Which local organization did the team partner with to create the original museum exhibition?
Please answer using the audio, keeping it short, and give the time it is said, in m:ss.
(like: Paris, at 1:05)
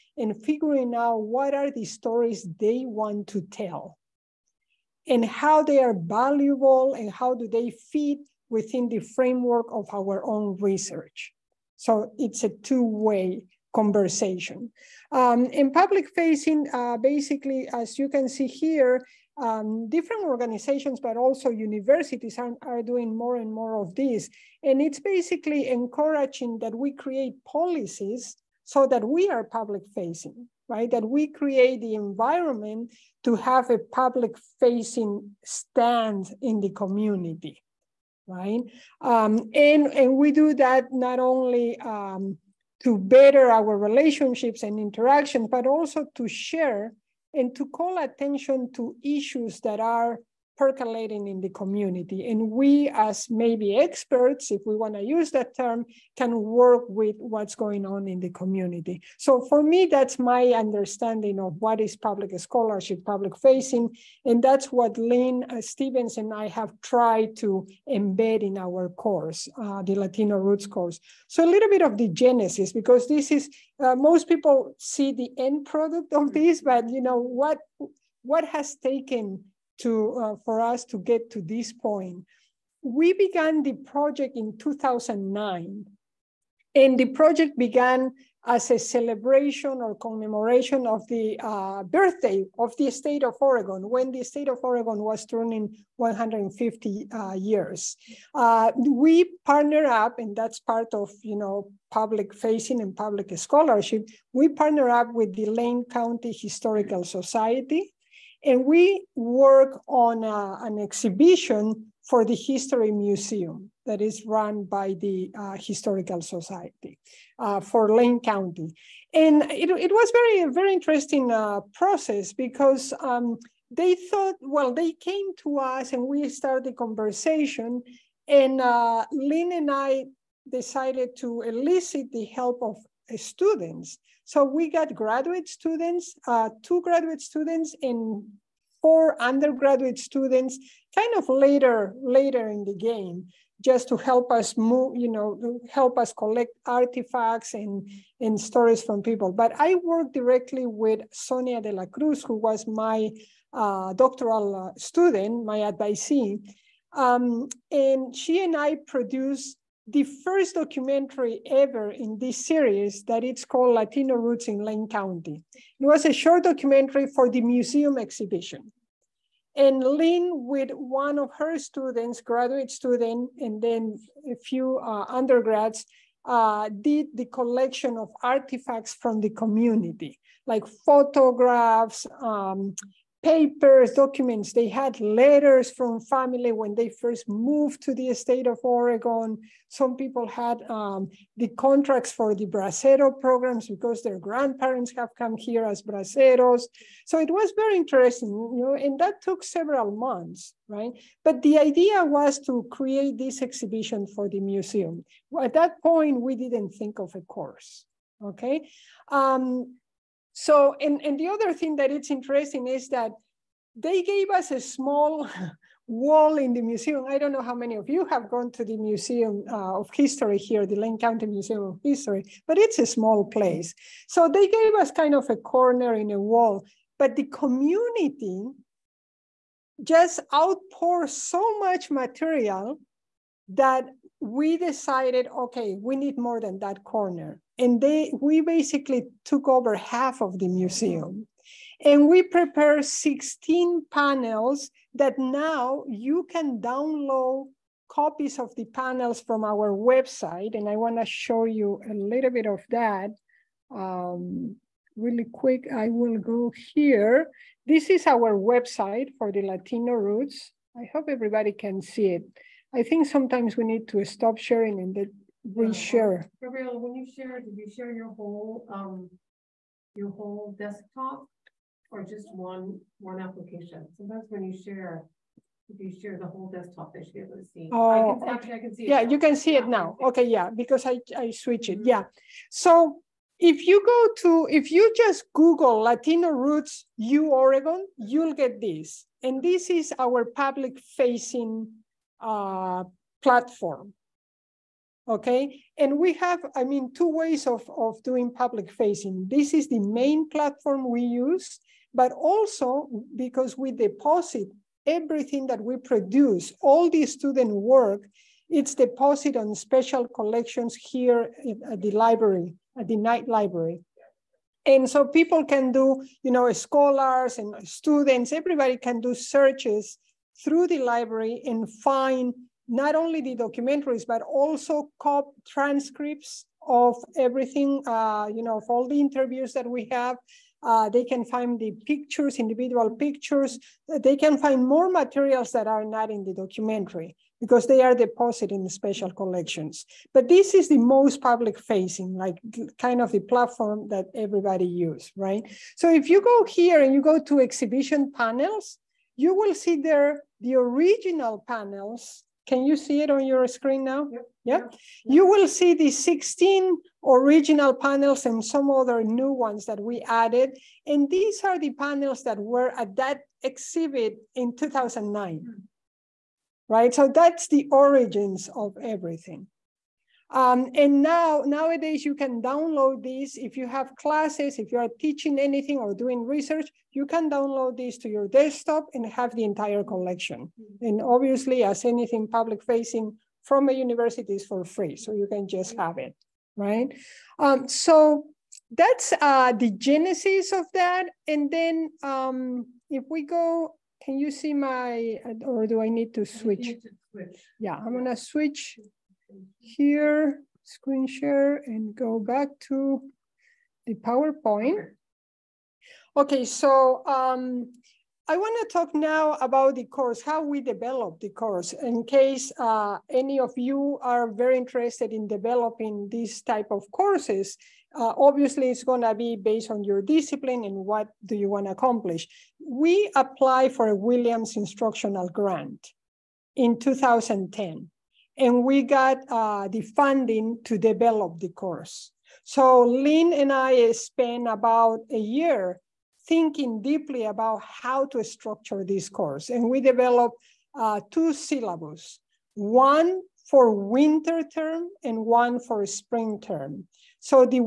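Lane County Historical Society, at 1:45.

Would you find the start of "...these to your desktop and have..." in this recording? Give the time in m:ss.
6:17.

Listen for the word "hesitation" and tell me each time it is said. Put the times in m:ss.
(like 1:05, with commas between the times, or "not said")
not said.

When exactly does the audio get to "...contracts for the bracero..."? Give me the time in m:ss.
3:11.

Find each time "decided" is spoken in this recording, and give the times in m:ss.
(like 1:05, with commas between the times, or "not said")
2:10, 3:54.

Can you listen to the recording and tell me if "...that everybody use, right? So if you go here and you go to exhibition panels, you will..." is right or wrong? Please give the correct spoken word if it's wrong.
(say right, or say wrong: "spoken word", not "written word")
right.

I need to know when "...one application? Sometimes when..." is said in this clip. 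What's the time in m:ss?
4:32.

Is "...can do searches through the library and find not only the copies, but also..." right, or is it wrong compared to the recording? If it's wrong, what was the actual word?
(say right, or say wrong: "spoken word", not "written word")
wrong: "documentaries", not "copies".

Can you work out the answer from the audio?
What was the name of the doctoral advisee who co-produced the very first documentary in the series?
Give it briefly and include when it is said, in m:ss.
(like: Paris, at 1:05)
Sonia de la Cruz, at 2:31.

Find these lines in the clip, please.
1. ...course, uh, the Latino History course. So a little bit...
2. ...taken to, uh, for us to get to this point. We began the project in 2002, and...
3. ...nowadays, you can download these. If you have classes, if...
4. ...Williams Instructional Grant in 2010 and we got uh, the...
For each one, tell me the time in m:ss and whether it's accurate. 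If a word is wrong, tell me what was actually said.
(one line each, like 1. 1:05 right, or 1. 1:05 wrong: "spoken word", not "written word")
1. 1:08 wrong: "Roots", not "History"
2. 1:18 wrong: "2009", not "2002"
3. 6:11 right
4. 7:03 right.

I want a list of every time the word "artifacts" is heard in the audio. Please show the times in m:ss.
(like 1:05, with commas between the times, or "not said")
2:26, 2:58.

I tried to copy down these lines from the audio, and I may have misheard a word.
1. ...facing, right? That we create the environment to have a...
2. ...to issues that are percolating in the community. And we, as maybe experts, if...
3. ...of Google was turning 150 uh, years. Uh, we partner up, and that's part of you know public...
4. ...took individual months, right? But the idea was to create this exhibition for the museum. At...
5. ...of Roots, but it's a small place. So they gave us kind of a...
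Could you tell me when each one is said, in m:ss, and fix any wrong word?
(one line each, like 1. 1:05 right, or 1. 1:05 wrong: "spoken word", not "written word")
1. 0:29 right
2. 0:48 right
3. 1:34 wrong: "Oregon", not "Google"
4. 3:19 wrong: "several", not "individual"
5. 3:41 wrong: "History", not "Roots".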